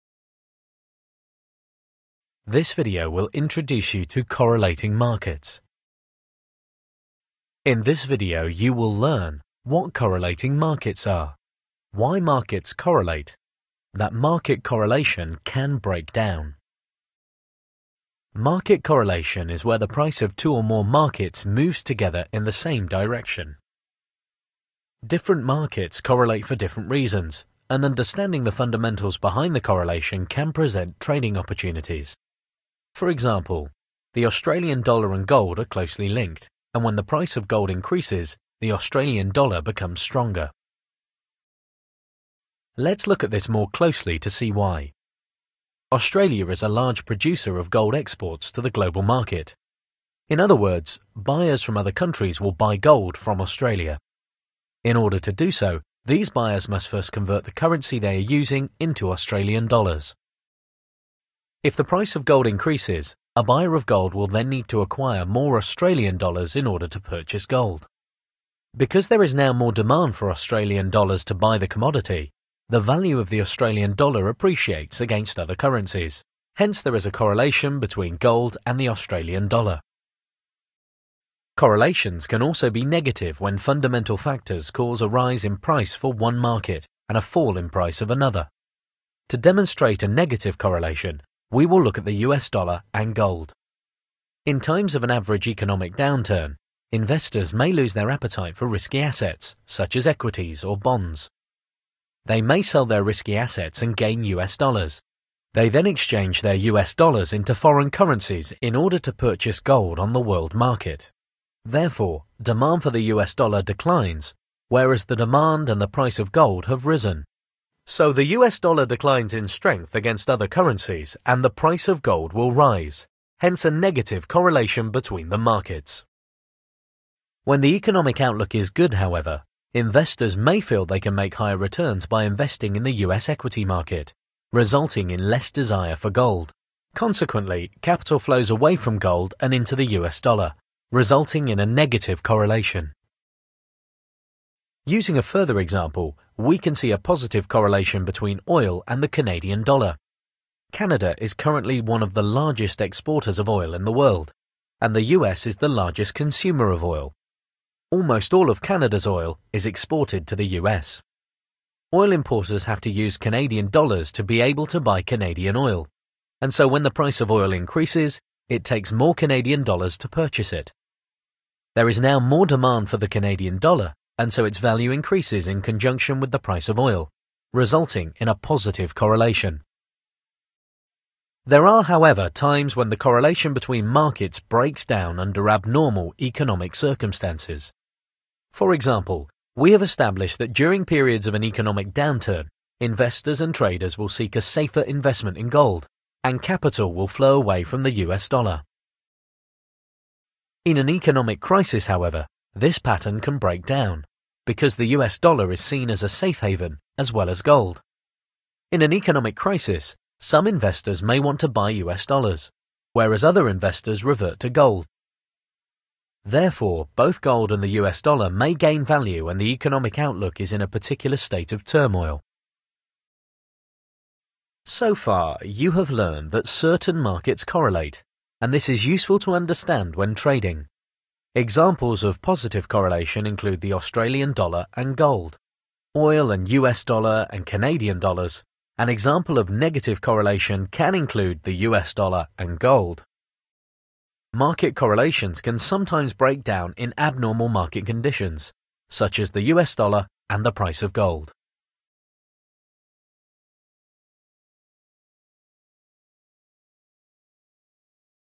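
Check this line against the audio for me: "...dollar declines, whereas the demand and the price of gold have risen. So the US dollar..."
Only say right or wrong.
right.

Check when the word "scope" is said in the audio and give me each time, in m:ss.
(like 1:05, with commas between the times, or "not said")
not said.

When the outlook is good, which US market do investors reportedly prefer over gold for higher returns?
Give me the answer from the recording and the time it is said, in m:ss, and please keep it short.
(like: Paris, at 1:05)
equity market, at 2:13.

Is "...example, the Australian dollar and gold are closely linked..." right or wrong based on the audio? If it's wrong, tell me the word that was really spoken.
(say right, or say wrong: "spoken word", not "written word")
right.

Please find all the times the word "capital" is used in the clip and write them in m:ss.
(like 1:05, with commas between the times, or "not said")
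2:17, 3:16.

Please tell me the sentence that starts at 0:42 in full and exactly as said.
Let's look at this more closely to see why.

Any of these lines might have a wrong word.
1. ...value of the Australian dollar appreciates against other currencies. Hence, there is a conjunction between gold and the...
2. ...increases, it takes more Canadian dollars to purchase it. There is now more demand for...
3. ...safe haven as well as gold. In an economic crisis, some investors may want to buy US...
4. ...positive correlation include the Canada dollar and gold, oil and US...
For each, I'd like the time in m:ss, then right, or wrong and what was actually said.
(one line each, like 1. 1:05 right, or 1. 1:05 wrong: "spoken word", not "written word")
1. 1:12 wrong: "correlation", not "conjunction"
2. 2:47 right
3. 3:26 right
4. 3:52 wrong: "Australian", not "Canada".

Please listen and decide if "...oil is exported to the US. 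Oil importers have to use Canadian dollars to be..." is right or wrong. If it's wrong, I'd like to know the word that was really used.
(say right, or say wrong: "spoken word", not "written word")
right.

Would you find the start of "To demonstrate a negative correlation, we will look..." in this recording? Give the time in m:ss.
1:29.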